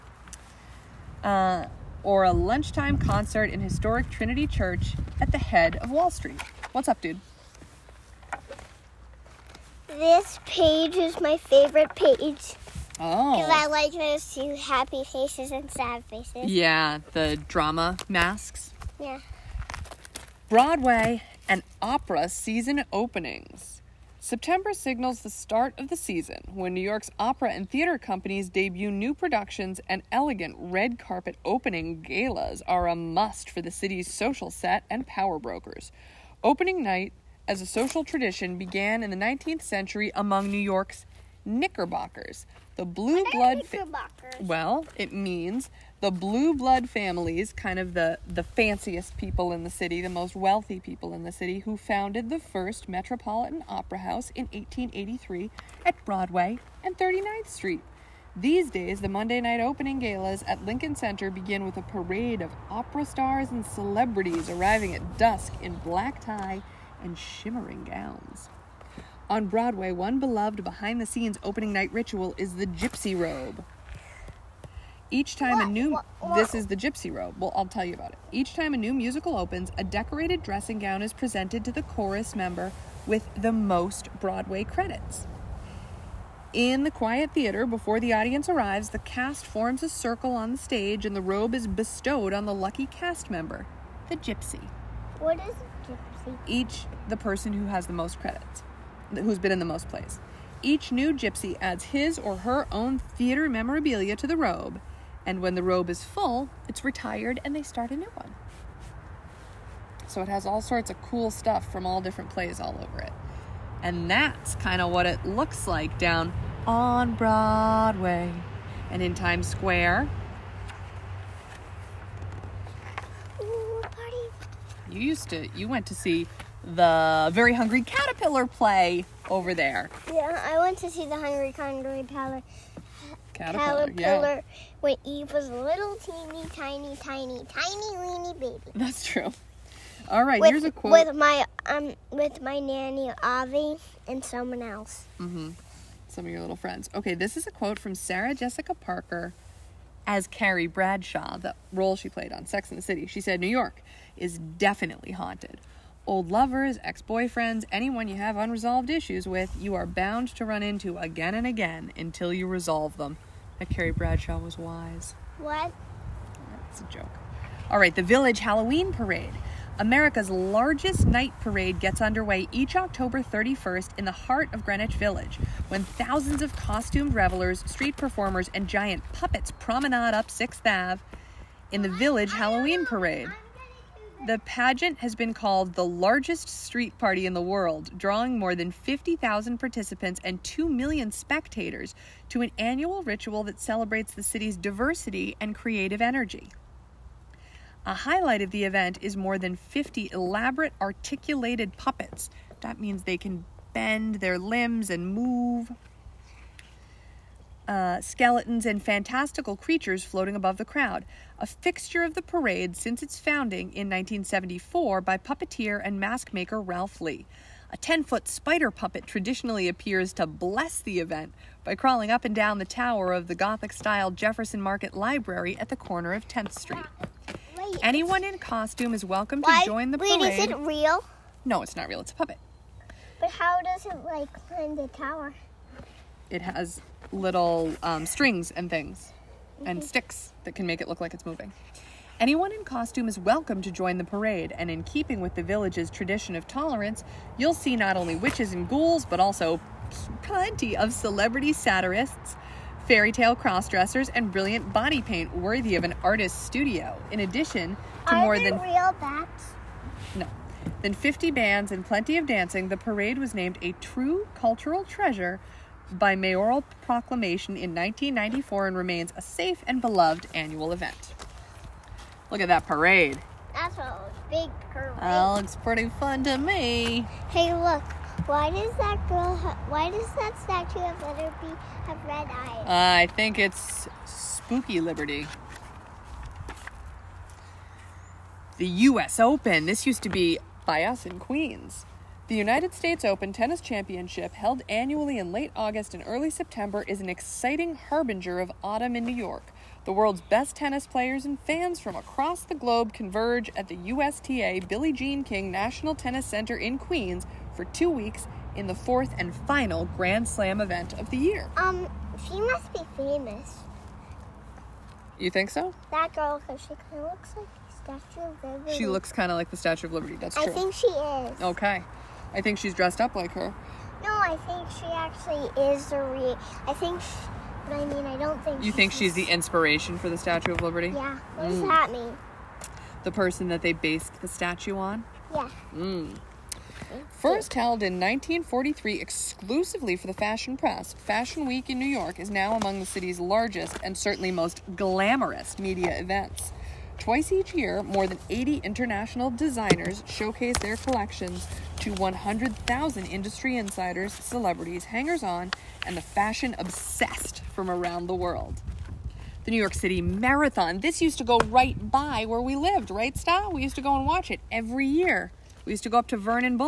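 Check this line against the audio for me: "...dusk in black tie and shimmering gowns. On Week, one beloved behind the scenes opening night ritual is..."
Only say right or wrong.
wrong.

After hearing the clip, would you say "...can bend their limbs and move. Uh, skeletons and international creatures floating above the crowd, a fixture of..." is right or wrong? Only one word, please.
wrong.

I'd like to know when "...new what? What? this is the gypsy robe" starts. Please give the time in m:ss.
1:15.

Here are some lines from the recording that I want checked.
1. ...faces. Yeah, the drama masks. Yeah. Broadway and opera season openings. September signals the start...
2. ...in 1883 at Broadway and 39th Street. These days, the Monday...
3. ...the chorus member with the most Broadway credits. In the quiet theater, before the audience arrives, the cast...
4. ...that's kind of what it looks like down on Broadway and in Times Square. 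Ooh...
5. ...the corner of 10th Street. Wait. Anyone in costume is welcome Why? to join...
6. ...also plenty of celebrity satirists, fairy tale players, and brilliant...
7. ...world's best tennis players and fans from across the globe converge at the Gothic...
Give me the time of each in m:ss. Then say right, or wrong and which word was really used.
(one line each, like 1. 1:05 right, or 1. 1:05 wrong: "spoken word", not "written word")
1. 0:16 right
2. 0:54 right
3. 1:21 right
4. 1:54 right
5. 3:45 right
6. 4:09 wrong: "crossdressers", not "players"
7. 4:59 wrong: "USTA", not "Gothic".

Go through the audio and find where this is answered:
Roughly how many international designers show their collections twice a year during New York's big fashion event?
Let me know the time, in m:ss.
5:47.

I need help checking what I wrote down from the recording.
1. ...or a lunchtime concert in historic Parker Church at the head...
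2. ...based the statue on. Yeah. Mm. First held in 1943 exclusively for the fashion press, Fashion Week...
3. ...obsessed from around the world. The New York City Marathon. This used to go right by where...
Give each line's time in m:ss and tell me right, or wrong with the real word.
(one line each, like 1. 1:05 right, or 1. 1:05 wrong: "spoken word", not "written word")
1. 0:02 wrong: "Trinity", not "Parker"
2. 5:33 right
3. 5:56 right.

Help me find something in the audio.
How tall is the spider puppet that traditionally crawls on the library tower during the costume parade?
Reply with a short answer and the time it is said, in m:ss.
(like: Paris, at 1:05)
10 feet, at 3:37.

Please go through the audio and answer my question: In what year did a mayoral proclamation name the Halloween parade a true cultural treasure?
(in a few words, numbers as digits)
1994.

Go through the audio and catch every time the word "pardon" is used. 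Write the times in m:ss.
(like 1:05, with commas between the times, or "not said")
not said.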